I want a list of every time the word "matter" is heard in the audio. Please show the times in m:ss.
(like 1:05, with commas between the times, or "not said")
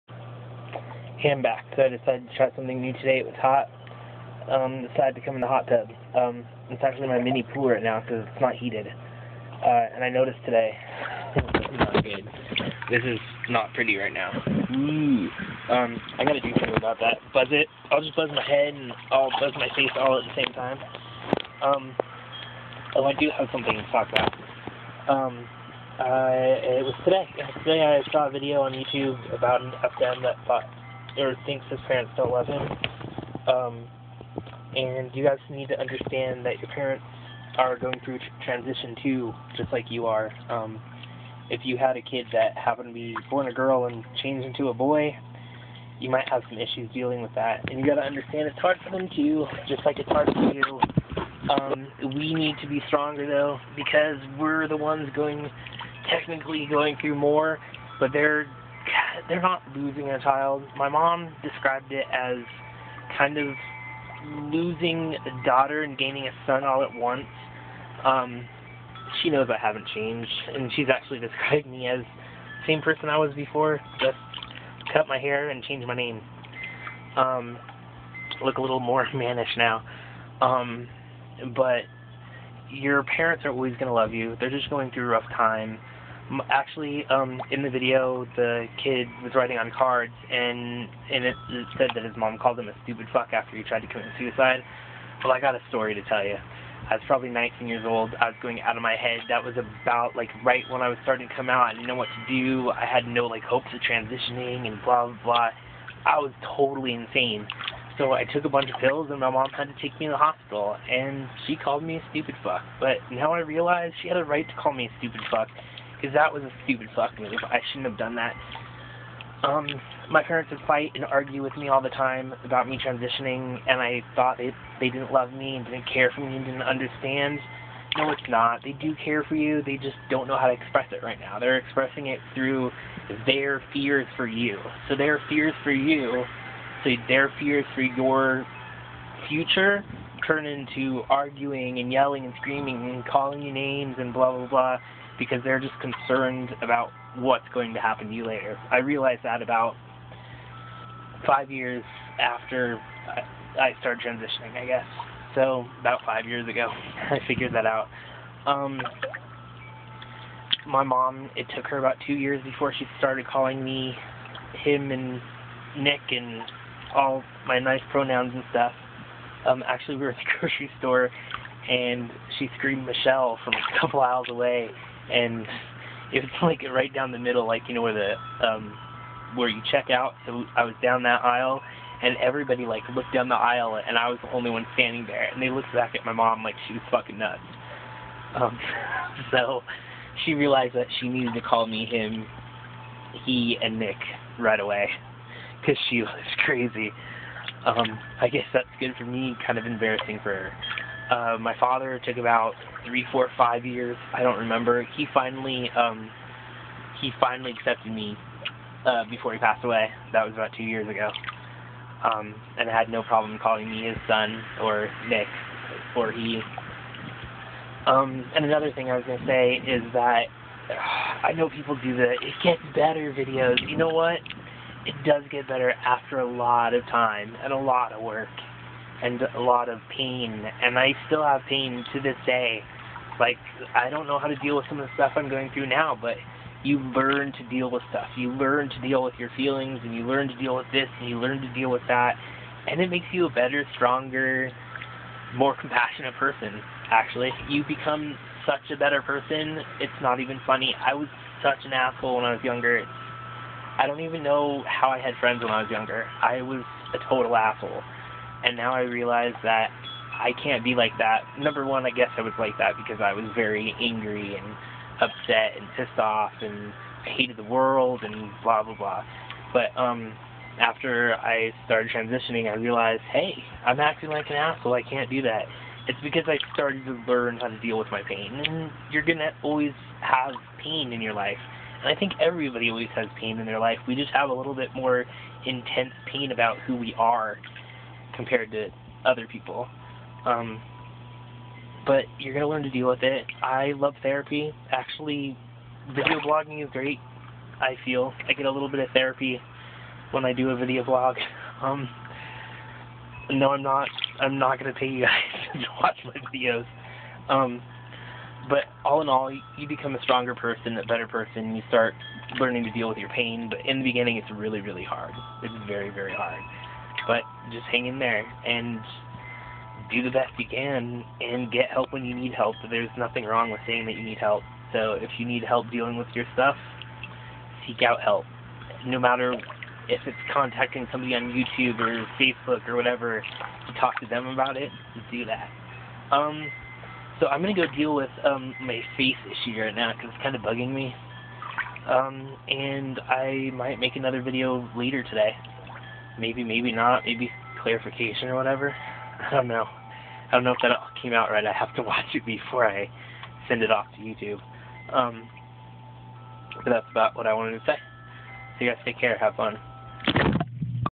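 5:28.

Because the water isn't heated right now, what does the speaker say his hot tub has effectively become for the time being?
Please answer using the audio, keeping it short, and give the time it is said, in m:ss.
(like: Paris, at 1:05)
mini pool, at 0:07.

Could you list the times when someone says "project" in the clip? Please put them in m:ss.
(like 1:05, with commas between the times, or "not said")
not said.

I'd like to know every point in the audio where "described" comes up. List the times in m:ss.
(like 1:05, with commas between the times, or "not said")
1:01, 1:11.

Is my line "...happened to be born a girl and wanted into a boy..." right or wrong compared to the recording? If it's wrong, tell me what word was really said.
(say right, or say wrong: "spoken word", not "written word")
wrong: "changed", not "wanted".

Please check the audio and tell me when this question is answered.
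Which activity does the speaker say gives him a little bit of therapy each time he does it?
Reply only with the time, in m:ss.
4:55.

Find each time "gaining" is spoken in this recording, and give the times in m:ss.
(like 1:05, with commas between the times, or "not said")
1:05.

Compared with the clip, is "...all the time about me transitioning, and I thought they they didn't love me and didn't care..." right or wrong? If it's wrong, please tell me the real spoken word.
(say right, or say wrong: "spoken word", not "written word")
right.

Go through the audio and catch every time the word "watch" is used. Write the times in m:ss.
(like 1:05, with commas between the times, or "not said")
5:05, 5:51.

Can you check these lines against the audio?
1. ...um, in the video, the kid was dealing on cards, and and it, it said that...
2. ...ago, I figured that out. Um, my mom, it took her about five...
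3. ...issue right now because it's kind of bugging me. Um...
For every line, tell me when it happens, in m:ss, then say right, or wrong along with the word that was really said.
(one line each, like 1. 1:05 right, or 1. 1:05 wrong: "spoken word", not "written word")
1. 1:27 wrong: "writing", not "dealing"
2. 2:36 wrong: "two", not "five"
3. 5:39 right.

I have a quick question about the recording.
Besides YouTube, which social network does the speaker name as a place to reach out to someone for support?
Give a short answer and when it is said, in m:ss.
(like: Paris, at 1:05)
Facebook, at 5:32.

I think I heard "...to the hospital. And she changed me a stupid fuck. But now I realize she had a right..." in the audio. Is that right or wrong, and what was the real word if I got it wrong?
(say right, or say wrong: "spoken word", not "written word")
wrong: "called", not "changed".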